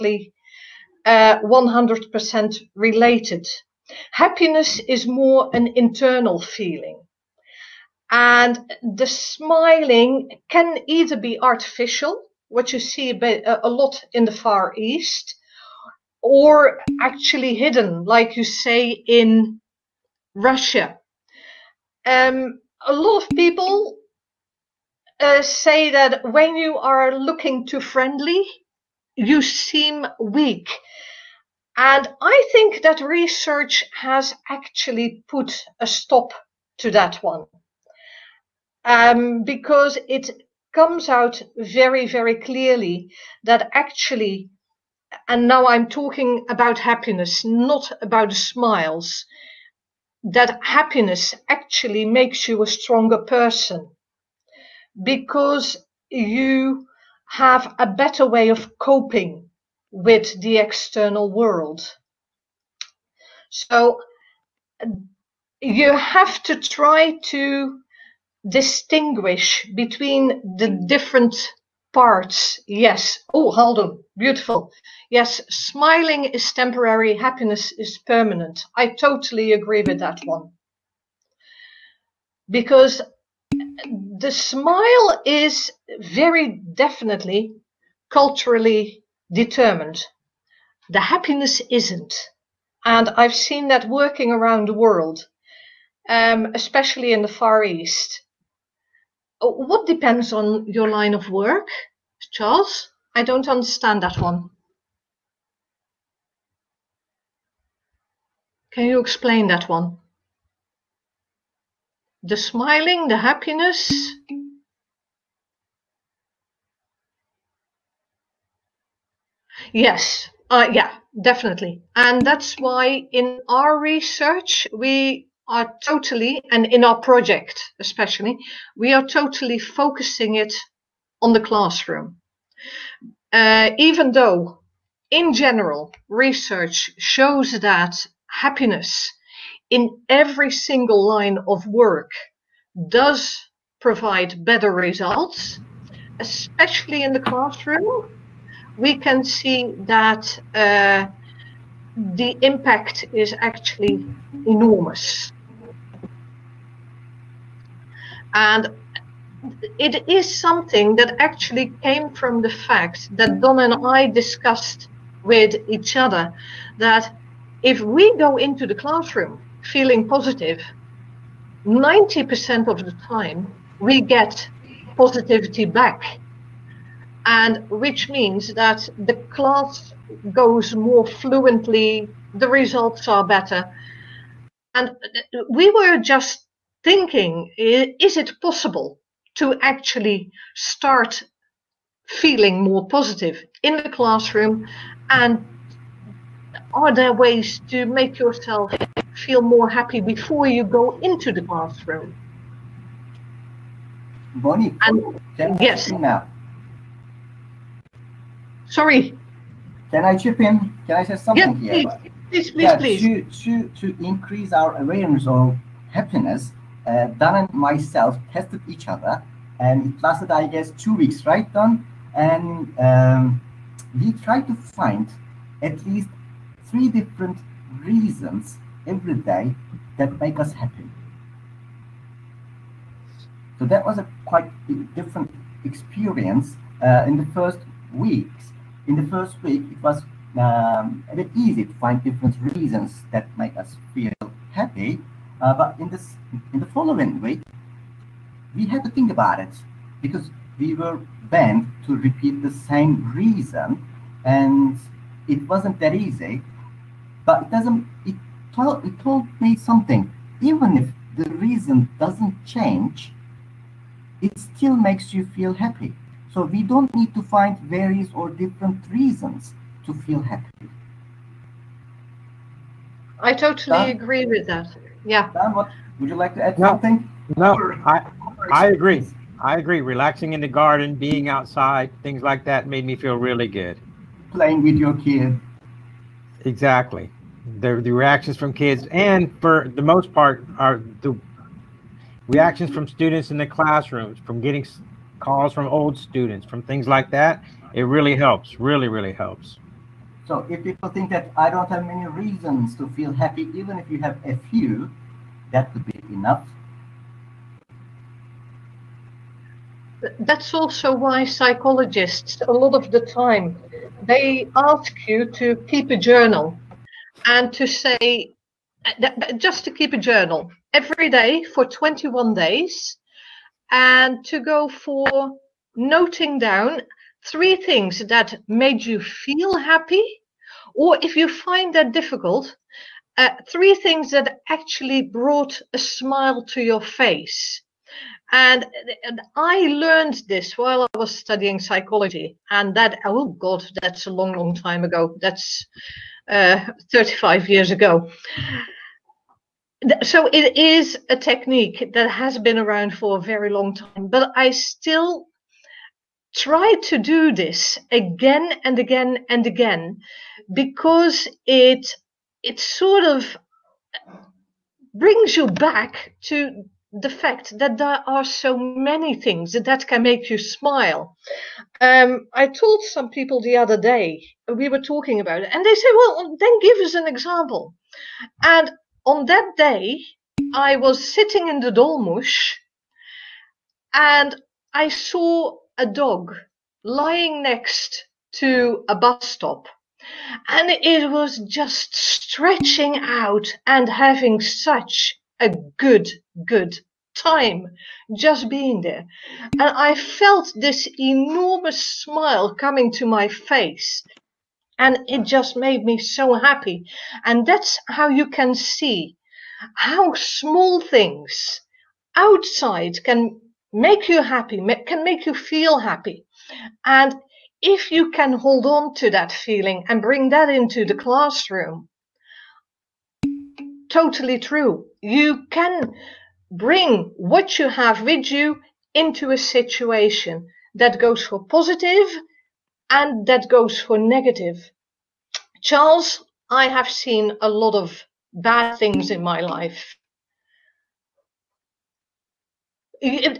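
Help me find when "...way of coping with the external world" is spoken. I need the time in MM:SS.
00:58.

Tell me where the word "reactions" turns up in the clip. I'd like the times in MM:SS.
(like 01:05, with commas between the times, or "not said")
04:47, 04:52.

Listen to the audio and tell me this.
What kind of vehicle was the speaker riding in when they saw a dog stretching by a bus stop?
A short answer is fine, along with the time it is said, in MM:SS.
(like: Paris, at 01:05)
dolmush, at 06:21.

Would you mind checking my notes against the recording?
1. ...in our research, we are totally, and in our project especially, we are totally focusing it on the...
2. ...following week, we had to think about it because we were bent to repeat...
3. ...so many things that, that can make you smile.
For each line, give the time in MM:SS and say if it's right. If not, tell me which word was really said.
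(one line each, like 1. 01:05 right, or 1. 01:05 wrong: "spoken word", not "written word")
1. 02:03 right
2. 04:06 right
3. 06:08 right.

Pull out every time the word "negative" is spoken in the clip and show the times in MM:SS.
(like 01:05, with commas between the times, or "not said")
07:13.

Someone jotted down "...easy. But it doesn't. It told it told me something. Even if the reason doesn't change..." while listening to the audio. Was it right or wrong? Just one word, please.
right.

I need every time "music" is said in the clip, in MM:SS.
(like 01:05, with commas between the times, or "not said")
not said.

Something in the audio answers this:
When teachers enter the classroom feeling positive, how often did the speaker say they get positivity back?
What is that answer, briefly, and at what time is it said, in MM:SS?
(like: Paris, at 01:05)
90%, at 02:51.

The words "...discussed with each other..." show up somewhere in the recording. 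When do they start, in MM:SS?
02:44.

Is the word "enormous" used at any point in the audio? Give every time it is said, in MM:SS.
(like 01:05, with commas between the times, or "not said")
02:34, 06:40.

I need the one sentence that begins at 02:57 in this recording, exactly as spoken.
And which means that the class goes more fluently, the results are better.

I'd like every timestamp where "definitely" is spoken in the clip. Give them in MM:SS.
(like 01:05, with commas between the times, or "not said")
01:26, 02:01.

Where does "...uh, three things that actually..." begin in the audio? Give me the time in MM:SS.
05:33.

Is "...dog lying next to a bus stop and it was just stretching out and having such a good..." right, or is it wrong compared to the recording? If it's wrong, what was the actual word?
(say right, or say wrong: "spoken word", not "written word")
right.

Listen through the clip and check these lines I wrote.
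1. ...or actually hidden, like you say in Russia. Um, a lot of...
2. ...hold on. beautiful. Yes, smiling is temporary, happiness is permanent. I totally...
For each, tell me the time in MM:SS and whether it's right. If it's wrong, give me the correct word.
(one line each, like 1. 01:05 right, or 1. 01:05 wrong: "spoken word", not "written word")
1. 00:16 right
2. 01:13 right.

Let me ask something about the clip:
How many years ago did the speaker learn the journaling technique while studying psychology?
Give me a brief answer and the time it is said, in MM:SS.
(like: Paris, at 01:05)
35, at 05:46.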